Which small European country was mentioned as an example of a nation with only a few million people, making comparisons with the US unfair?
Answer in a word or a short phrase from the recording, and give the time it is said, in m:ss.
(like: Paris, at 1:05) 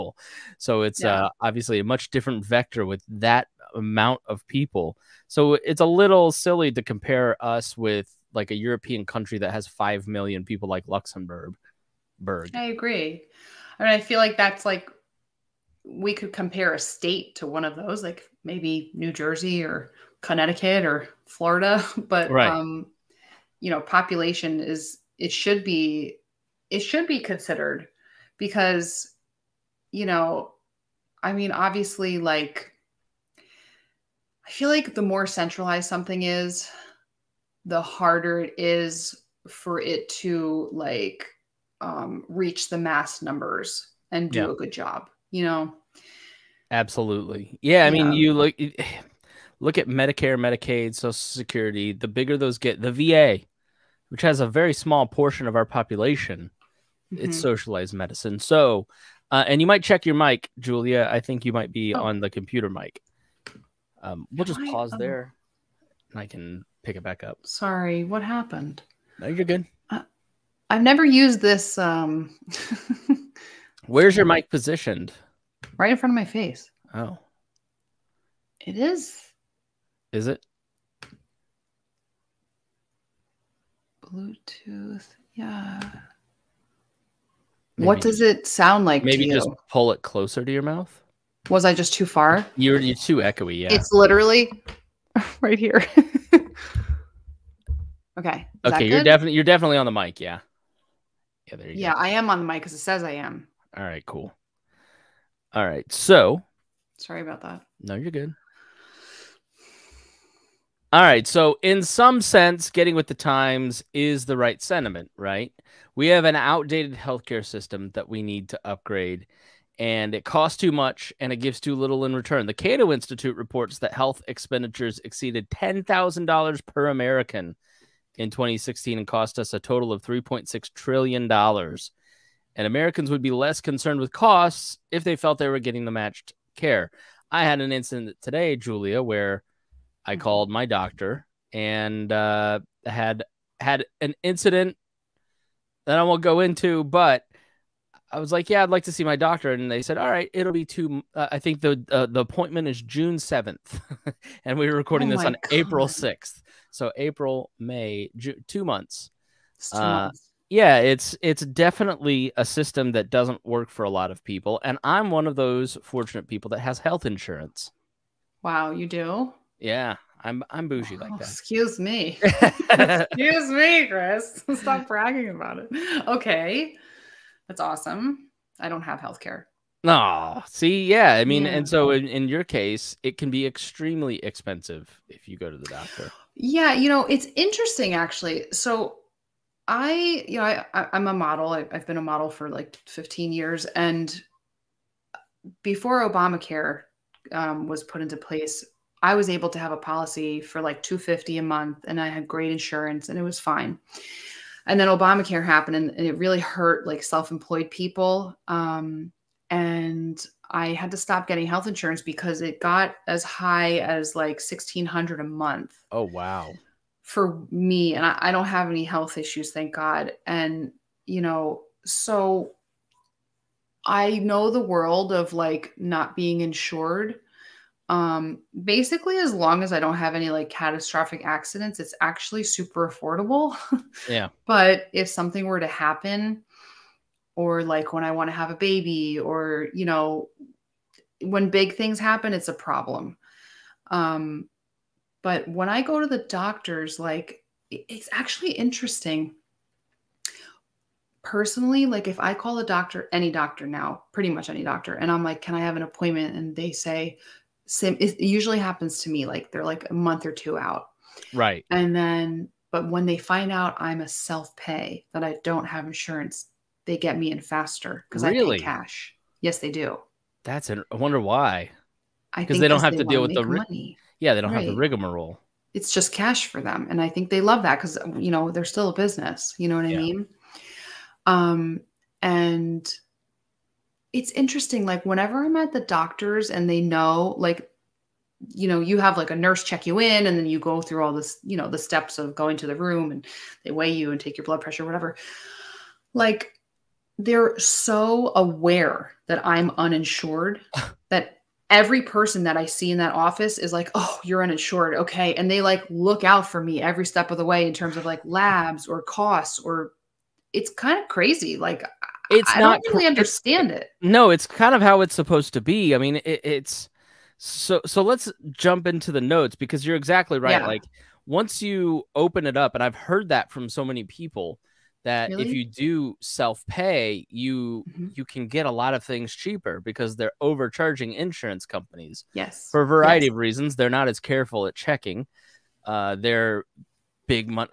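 Luxembourg, at 0:10.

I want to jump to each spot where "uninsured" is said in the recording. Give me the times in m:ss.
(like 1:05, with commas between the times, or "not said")
4:59, 5:04.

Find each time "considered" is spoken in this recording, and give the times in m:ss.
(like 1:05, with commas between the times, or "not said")
0:27.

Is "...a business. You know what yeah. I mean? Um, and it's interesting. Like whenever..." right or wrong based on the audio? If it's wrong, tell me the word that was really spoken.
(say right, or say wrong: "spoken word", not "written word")
right.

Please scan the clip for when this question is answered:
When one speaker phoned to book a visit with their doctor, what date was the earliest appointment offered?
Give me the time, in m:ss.
2:32.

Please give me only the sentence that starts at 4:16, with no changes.
And they say, same, it usually happens to me, like they're like a month or two out.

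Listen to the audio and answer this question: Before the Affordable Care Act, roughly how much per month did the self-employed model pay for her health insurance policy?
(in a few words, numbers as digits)
$250.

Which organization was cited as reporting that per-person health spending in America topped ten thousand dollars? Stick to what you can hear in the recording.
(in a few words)
Cato Institute.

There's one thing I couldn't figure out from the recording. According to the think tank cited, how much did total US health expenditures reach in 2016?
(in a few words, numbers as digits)
$3.6 trillion.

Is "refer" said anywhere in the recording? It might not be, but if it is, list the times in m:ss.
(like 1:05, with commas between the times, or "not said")
not said.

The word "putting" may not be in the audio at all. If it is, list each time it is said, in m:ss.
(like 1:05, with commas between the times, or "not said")
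not said.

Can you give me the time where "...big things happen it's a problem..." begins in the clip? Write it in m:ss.
4:01.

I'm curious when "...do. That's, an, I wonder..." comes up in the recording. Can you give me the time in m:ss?
4:29.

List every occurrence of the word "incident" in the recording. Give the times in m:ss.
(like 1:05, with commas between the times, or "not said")
2:17, 2:24.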